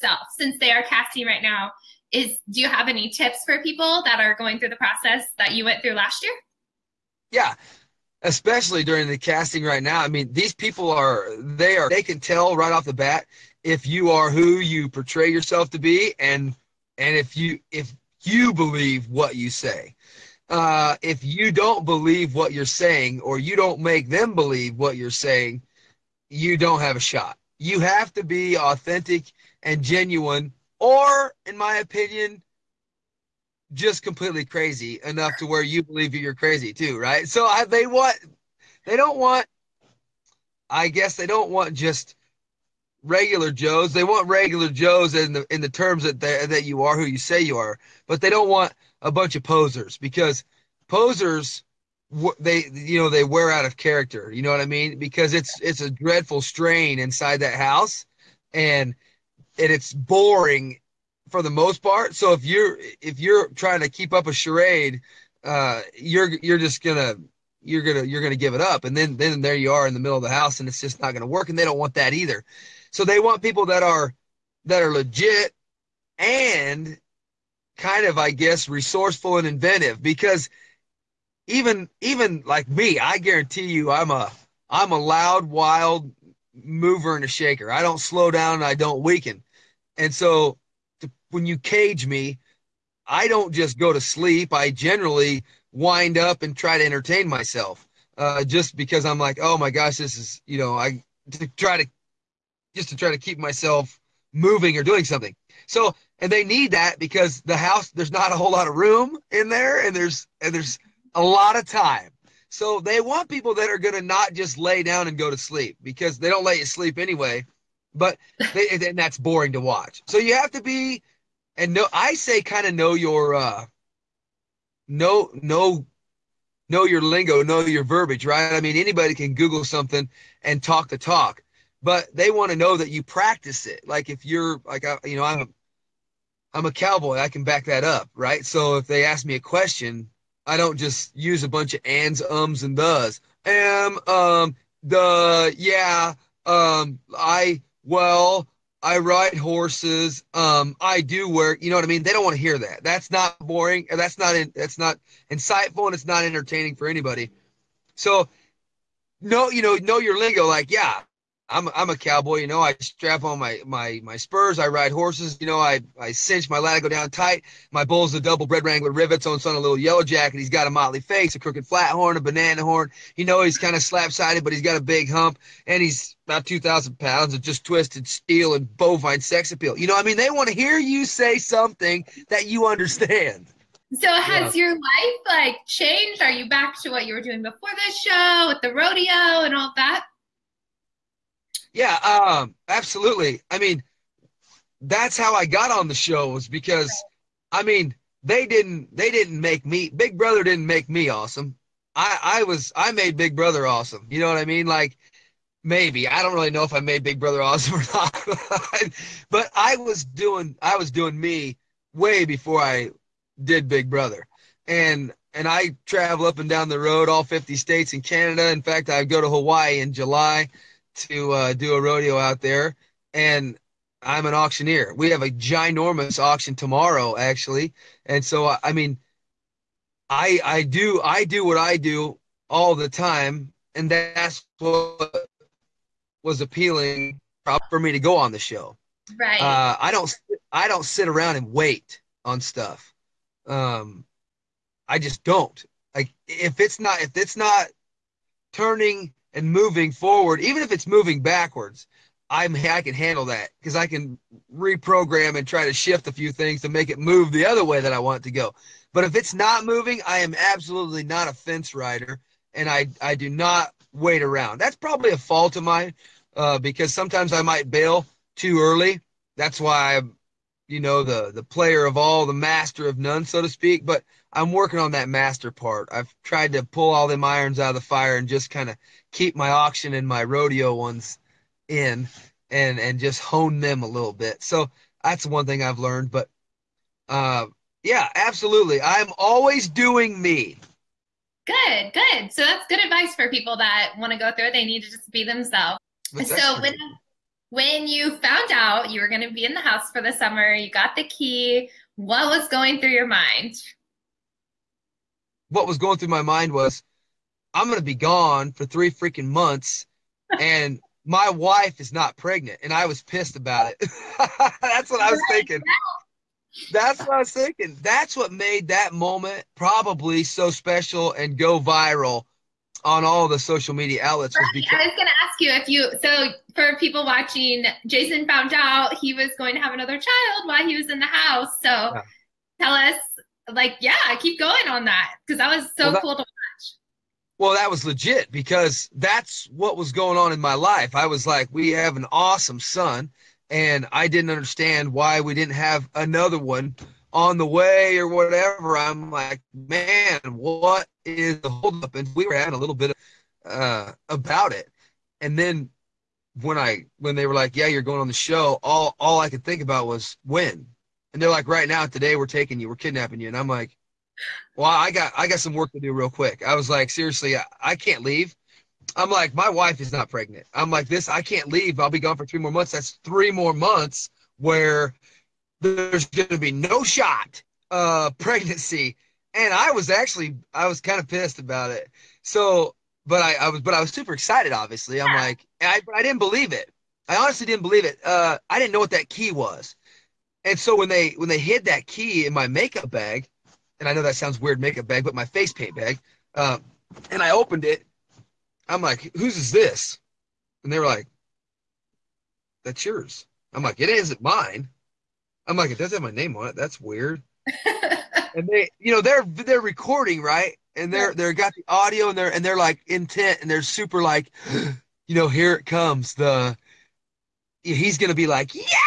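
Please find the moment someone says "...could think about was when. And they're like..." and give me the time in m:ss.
5:59.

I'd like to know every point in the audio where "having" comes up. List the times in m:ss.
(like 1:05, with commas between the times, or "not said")
5:52.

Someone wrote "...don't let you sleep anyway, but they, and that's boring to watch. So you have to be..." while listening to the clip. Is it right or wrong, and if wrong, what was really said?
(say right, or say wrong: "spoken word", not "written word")
right.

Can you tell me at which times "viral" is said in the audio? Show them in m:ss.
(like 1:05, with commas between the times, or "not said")
5:21.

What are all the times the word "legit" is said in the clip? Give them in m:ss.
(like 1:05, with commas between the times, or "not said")
1:14, 5:37.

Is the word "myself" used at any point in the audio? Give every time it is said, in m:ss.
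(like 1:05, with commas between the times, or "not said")
1:37, 1:43.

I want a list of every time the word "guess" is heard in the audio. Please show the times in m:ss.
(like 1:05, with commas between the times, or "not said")
0:40, 1:18.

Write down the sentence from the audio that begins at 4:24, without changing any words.
That's probably a fault of mine uh, because sometimes I might bail too early.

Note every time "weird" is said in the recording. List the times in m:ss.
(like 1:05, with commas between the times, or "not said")
6:34, 6:46.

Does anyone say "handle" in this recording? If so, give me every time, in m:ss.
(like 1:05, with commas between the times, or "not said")
4:12.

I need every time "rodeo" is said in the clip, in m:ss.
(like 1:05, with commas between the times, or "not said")
3:08, 3:41, 4:40.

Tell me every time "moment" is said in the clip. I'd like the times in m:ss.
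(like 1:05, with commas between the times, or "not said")
5:18.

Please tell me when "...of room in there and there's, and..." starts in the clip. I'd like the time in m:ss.
1:48.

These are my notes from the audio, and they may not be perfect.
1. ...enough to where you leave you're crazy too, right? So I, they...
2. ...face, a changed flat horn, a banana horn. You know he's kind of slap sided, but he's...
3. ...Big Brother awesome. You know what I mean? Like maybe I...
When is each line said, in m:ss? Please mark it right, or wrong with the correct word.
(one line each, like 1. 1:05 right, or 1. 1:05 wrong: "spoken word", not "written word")
1. 0:35 wrong: "believe", not "leave"
2. 2:50 wrong: "crooked", not "changed"
3. 3:23 right.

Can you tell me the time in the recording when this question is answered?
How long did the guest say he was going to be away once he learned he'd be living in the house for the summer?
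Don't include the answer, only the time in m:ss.
5:08.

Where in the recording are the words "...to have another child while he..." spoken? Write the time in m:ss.
5:29.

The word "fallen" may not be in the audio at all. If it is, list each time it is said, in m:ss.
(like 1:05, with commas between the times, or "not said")
not said.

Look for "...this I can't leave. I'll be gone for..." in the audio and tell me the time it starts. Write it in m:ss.
6:10.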